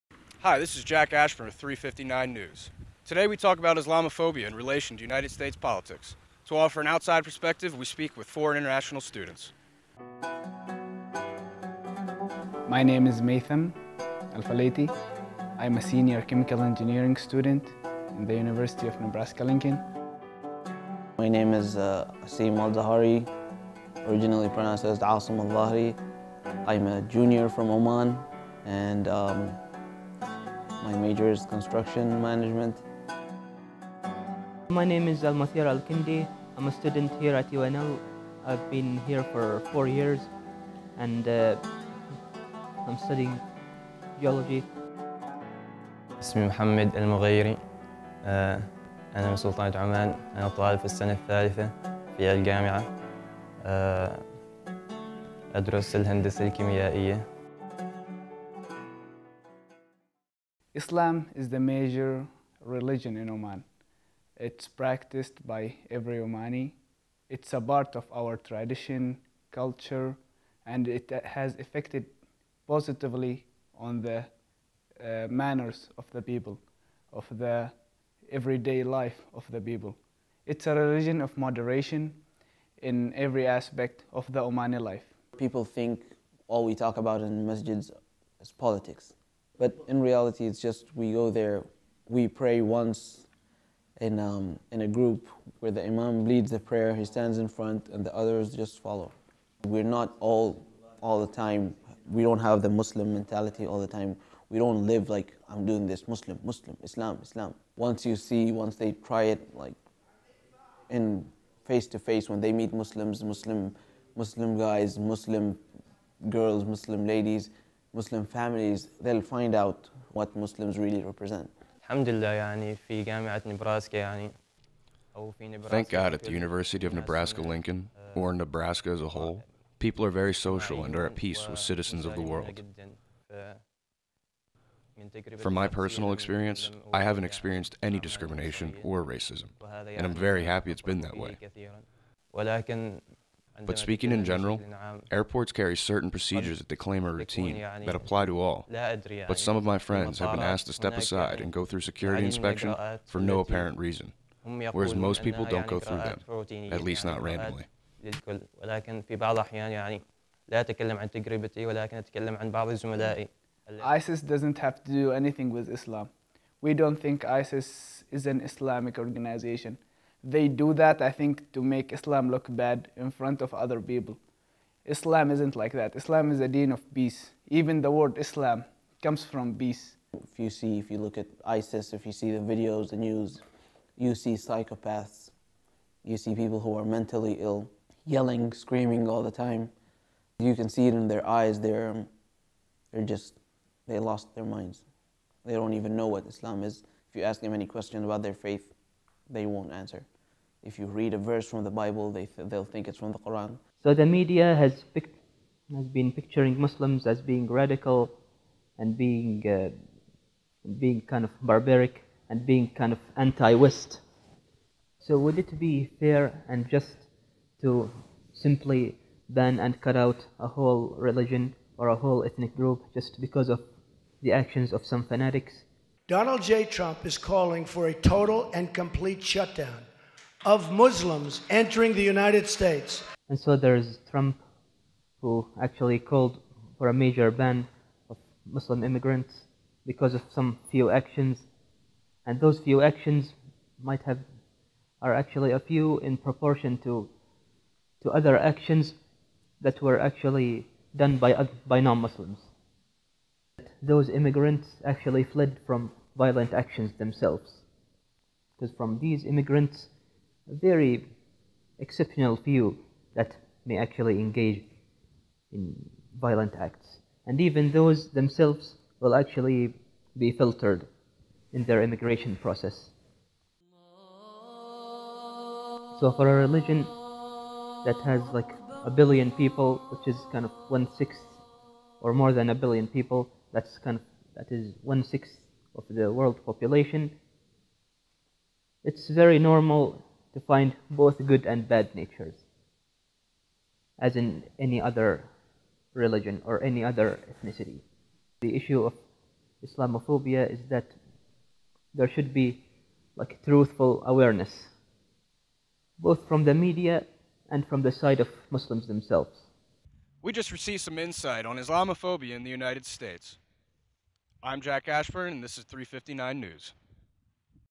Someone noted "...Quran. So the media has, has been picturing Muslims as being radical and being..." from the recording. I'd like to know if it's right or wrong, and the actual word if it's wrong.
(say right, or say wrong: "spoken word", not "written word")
right.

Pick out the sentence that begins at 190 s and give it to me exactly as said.
You can see it in their eyes.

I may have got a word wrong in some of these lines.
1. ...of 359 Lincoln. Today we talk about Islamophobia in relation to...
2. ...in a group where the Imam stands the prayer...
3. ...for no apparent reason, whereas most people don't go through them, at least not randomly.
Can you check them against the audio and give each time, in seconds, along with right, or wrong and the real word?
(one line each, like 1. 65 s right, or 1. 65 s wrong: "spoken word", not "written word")
1. 1 s wrong: "News", not "Lincoln"
2. 94 s wrong: "leads", not "stands"
3. 153 s right.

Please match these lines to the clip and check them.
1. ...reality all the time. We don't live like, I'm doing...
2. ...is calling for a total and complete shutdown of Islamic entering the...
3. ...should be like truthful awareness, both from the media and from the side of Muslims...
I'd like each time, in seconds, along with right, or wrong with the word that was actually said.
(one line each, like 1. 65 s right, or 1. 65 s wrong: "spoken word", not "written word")
1. 103 s wrong: "mentality", not "reality"
2. 227 s wrong: "Muslims", not "Islamic"
3. 302 s right.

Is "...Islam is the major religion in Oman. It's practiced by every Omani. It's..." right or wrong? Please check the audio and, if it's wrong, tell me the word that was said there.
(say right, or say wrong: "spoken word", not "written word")
right.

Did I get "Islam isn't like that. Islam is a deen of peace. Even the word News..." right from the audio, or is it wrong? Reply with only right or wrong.
wrong.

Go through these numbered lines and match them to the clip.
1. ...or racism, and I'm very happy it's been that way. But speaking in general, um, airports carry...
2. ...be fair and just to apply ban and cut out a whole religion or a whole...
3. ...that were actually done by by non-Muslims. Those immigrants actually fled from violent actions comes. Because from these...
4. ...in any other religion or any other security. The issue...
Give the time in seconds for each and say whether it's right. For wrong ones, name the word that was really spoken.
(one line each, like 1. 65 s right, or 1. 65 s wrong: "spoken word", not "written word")
1. 138 s right
2. 215 s wrong: "simply", not "apply"
3. 249 s wrong: "themselves", not "comes"
4. 294 s wrong: "ethnicity", not "security".